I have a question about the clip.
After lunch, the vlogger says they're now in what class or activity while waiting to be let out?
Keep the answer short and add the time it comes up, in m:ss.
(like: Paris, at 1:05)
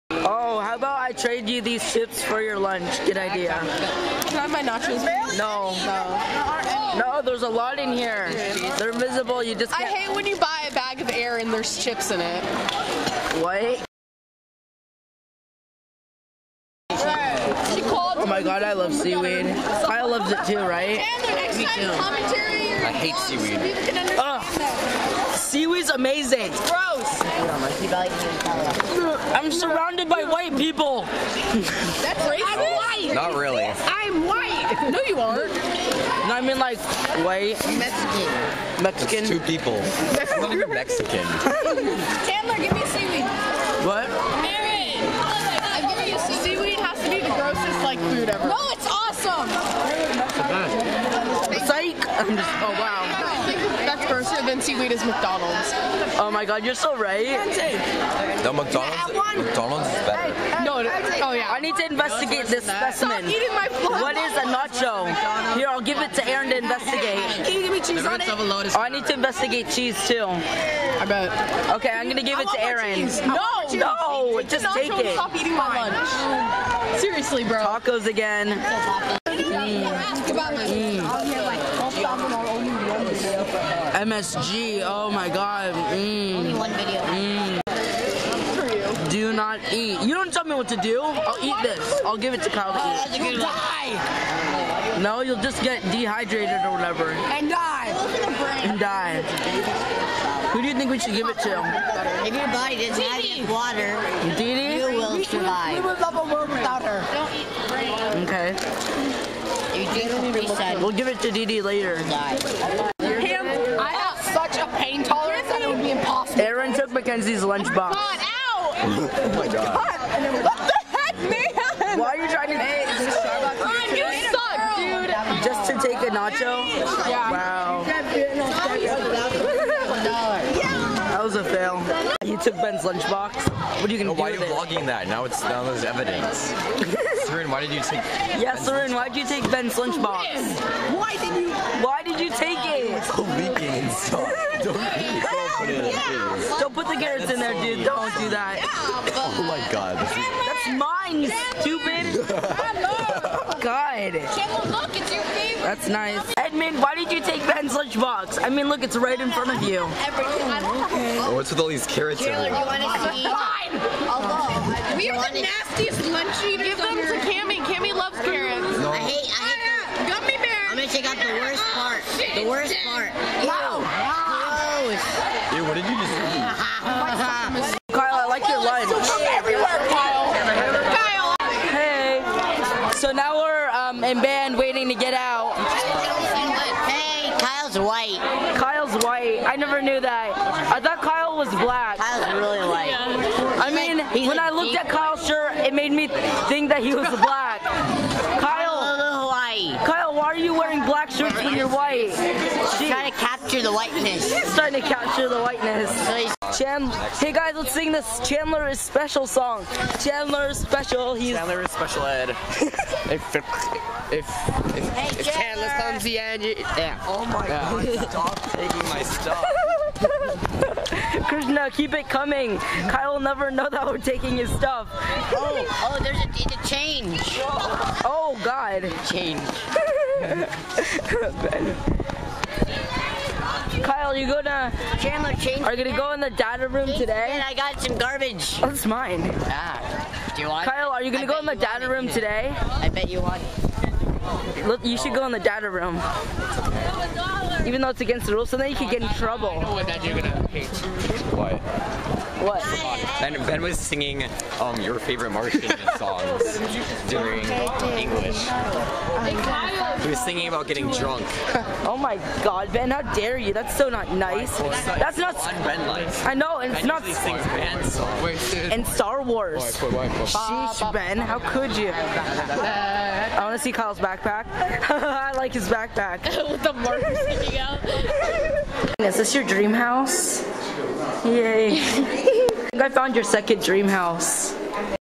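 Band, at 3:04.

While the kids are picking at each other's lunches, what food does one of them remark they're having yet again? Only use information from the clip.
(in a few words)
Tacos.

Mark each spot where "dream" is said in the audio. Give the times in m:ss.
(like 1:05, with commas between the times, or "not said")
4:39, 4:43.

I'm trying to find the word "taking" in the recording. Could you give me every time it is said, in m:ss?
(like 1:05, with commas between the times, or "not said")
3:38, 3:43.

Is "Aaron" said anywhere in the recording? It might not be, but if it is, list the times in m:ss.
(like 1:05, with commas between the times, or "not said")
0:44, 1:06, 1:12.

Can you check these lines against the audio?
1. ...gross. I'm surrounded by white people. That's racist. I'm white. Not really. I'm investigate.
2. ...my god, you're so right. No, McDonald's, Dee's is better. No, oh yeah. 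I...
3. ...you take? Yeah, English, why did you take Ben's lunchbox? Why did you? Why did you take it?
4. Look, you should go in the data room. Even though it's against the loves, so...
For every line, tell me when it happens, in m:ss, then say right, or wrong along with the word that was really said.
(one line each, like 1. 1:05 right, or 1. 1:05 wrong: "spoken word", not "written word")
1. 0:26 wrong: "white", not "investigate"
2. 0:56 wrong: "McDonald", not "Dee"
3. 2:17 wrong: "Sarin", not "English"
4. 4:04 wrong: "rules", not "loves".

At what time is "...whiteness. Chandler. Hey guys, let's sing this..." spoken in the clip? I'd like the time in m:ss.
3:25.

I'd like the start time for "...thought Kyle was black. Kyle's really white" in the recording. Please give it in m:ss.
3:10.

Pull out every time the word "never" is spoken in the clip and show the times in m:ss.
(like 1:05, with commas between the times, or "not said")
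3:09, 3:43.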